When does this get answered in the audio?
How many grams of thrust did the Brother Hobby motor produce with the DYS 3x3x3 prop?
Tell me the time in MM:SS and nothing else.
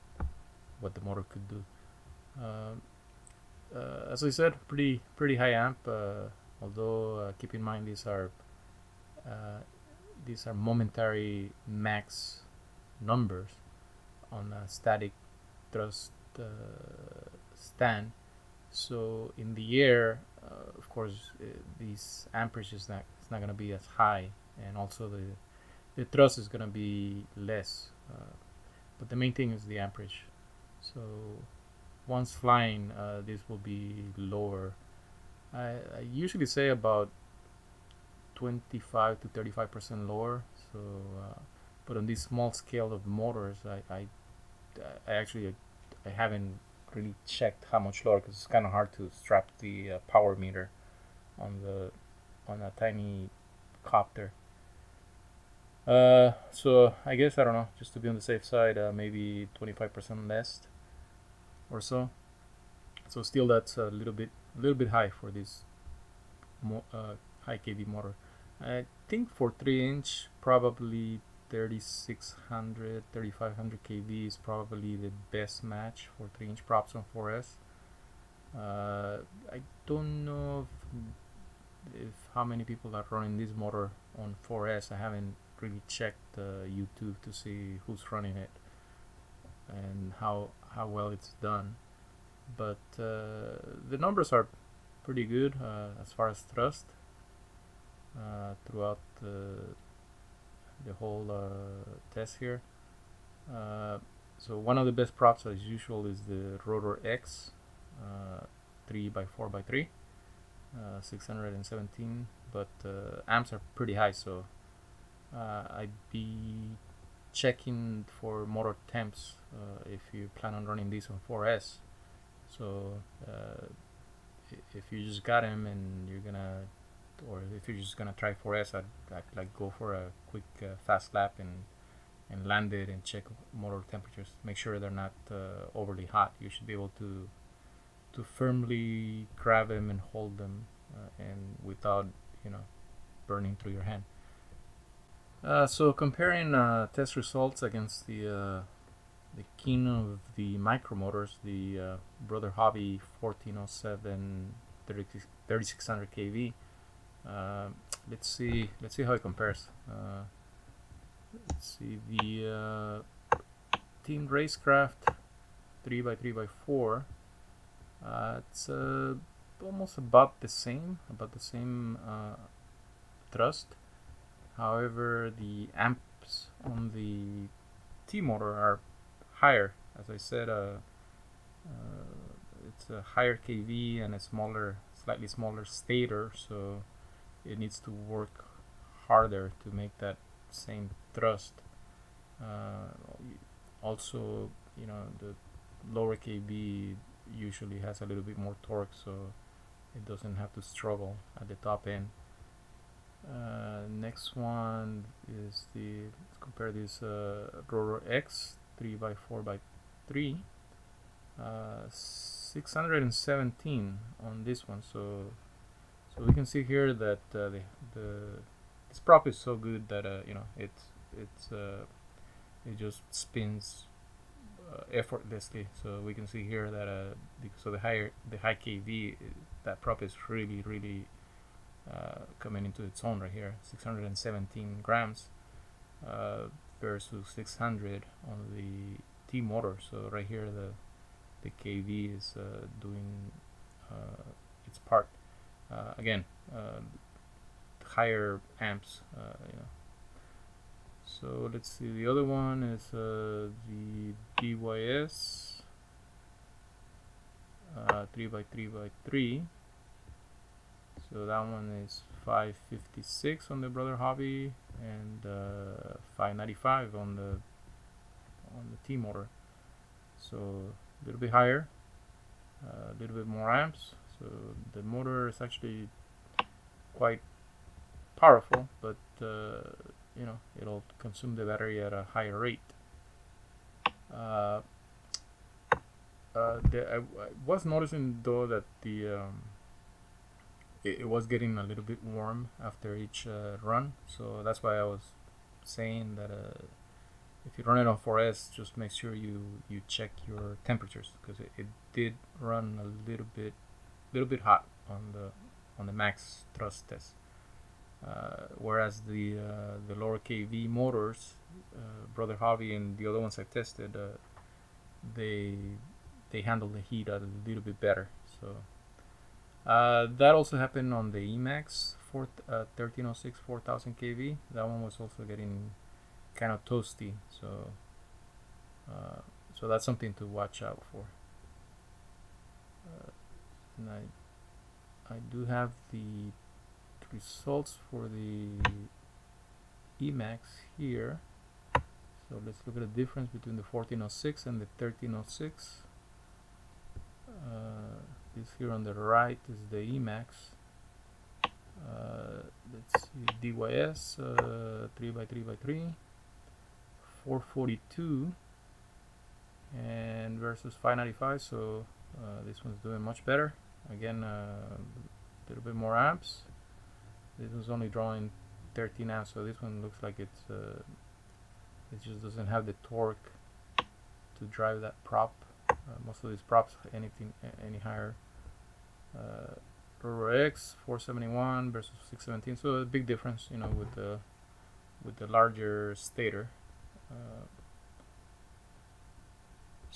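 04:22.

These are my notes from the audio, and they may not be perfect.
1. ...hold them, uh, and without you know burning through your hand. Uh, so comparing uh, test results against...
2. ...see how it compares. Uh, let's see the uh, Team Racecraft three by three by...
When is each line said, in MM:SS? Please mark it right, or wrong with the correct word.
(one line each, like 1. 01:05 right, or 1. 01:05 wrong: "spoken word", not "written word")
1. 02:20 right
2. 02:38 right.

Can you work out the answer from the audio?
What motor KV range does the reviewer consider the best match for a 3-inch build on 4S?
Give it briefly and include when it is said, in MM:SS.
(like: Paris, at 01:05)
3600 3500 kV, at 01:11.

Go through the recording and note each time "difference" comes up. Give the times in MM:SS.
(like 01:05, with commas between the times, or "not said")
05:43, 06:23.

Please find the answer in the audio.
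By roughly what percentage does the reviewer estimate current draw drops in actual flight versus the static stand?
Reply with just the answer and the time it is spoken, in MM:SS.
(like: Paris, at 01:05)
25 to 35 percent, at 00:38.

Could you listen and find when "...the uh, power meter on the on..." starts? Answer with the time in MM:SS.
00:49.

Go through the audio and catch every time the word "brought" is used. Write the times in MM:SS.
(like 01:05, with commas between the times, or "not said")
not said.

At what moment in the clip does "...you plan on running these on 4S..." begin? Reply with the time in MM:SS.
02:00.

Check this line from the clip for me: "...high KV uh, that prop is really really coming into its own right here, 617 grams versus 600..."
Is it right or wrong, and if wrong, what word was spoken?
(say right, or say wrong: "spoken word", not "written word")
right.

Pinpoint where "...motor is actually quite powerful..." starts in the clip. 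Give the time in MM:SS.
04:34.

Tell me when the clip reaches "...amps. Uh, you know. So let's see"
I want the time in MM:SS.
04:08.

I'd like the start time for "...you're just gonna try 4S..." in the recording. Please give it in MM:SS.
02:07.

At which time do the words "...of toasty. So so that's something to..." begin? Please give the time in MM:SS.
05:26.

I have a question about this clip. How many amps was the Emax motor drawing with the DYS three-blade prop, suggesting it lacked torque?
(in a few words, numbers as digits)
13 amps.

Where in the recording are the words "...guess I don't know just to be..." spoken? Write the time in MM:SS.
00:57.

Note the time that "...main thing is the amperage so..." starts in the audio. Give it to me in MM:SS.
00:29.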